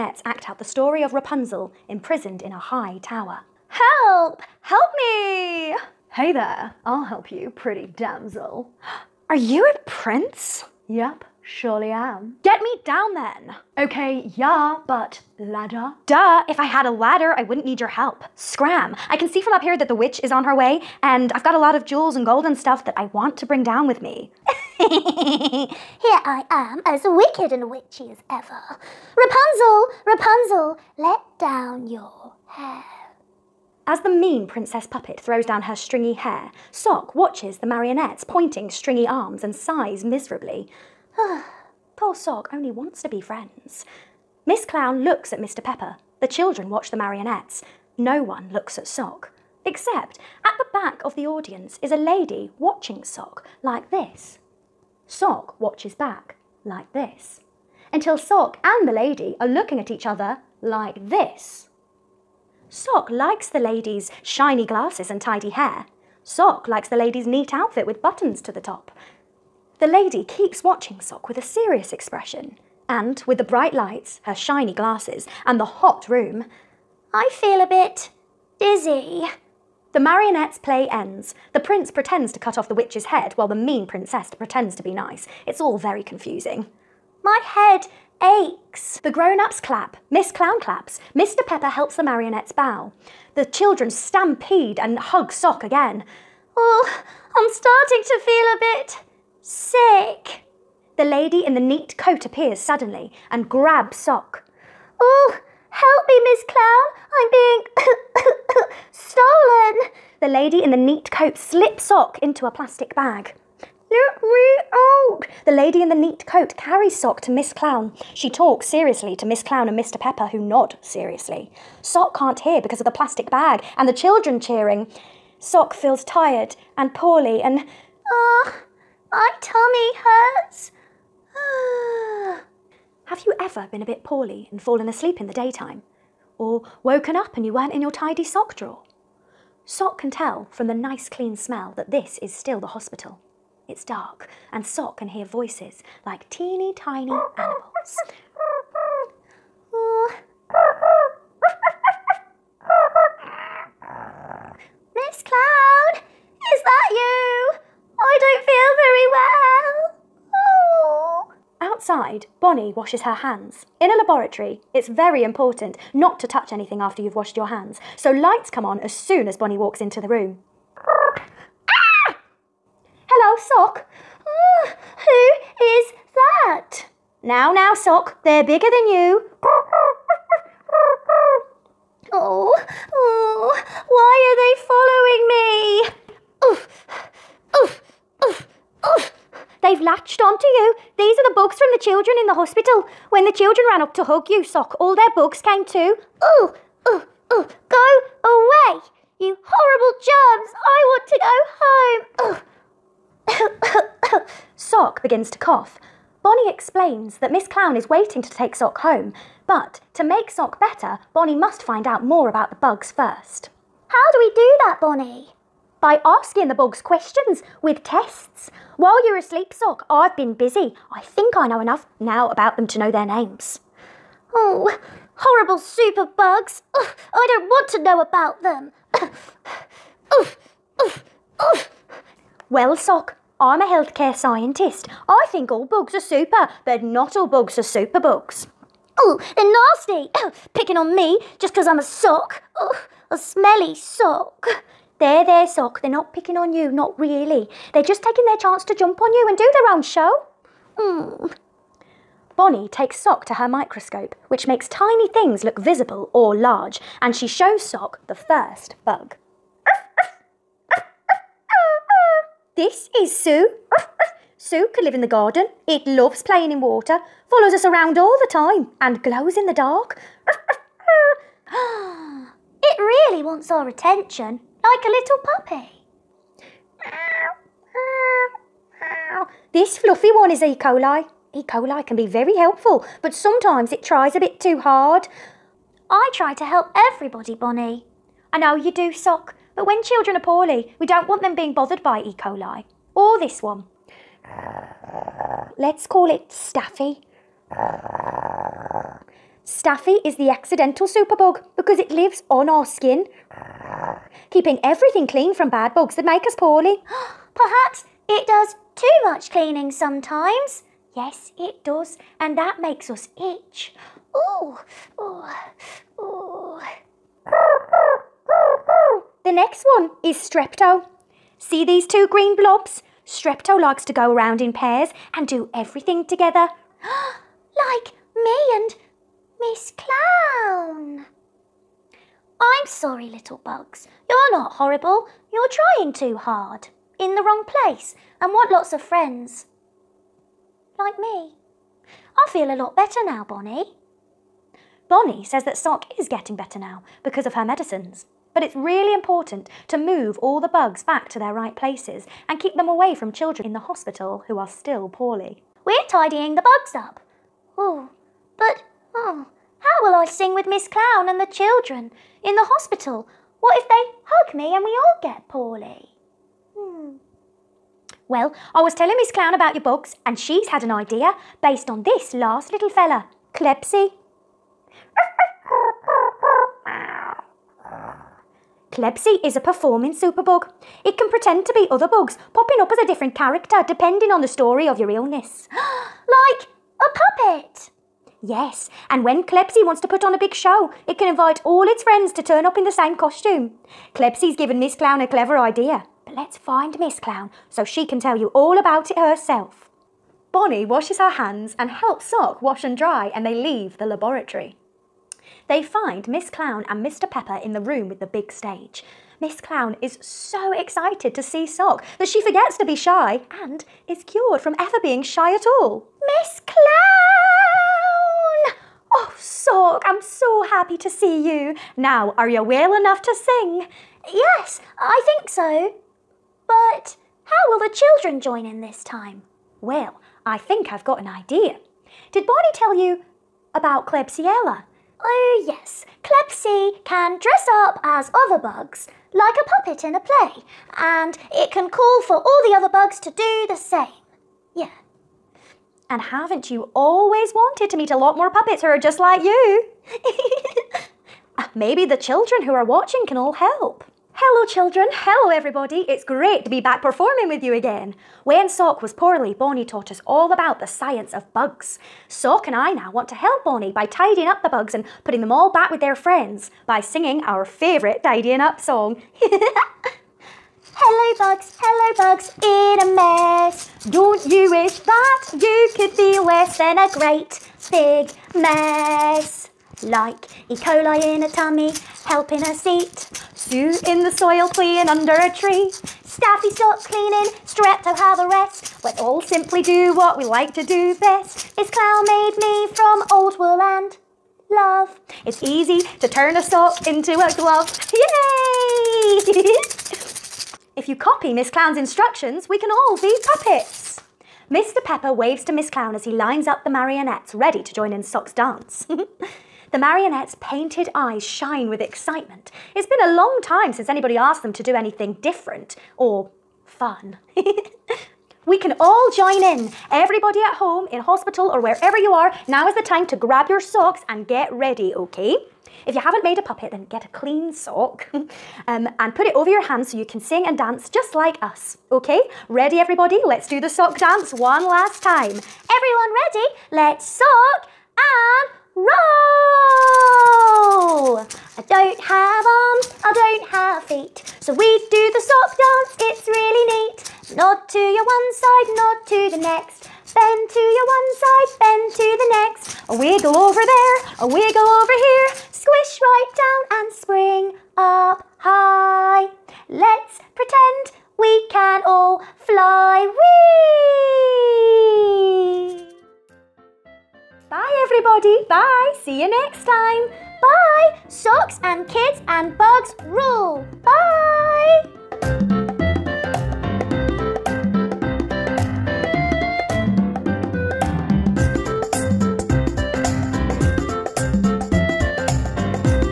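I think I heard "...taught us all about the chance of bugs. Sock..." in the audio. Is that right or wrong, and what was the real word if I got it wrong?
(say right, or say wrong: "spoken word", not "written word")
wrong: "science", not "chance".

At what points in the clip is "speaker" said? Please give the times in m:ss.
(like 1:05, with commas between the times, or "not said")
not said.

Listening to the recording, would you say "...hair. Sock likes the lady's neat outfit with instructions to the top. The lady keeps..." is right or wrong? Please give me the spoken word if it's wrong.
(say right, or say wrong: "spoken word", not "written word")
wrong: "buttons", not "instructions".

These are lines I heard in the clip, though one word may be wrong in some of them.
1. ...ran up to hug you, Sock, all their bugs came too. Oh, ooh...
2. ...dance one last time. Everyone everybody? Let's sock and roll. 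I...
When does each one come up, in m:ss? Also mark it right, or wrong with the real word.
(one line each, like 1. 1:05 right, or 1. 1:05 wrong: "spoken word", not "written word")
1. 3:13 right
2. 8:53 wrong: "ready", not "everybody".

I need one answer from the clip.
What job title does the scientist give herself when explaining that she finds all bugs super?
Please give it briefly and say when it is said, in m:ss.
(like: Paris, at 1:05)
healthcare scientist, at 3:53.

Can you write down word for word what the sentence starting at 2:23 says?
It's dark and Sock can hear voices like teeny tiny animals.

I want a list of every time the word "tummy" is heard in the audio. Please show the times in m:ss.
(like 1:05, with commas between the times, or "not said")
2:09, 8:01.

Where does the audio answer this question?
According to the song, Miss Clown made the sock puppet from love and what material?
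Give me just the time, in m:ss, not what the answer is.
8:13.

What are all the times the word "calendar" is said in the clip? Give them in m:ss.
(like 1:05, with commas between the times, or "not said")
not said.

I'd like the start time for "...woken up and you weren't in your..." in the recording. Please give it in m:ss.
2:16.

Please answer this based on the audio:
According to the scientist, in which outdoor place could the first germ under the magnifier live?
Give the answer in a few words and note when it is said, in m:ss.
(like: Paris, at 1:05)
the garden, at 4:25.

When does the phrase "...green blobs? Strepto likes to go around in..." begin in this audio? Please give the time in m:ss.
5:22.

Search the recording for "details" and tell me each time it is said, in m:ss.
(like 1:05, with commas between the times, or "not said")
not said.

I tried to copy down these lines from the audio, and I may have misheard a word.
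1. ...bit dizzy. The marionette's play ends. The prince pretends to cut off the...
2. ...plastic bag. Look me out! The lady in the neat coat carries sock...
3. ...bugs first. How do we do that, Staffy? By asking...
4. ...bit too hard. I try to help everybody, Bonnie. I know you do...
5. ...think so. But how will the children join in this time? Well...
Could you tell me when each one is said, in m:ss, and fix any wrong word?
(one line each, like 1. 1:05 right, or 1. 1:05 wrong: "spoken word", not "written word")
1. 1:17 right
2. 1:52 right
3. 3:32 wrong: "Bonnie", not "Staffy"
4. 4:44 right
5. 7:05 right.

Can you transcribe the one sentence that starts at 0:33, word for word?
As the mean princess puppet throws down her stringy hair, Sock watches the marionette's pointing stringy arms and sighs miserably.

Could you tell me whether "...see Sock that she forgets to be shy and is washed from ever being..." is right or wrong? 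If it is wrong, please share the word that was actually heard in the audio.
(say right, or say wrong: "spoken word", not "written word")
wrong: "cured", not "washed".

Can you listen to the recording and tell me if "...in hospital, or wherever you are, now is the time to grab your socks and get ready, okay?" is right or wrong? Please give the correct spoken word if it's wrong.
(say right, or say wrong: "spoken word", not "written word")
right.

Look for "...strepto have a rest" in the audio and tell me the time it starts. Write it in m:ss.
8:07.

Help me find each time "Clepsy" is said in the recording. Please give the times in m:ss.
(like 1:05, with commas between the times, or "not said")
6:13, 6:18, 6:29, 6:33.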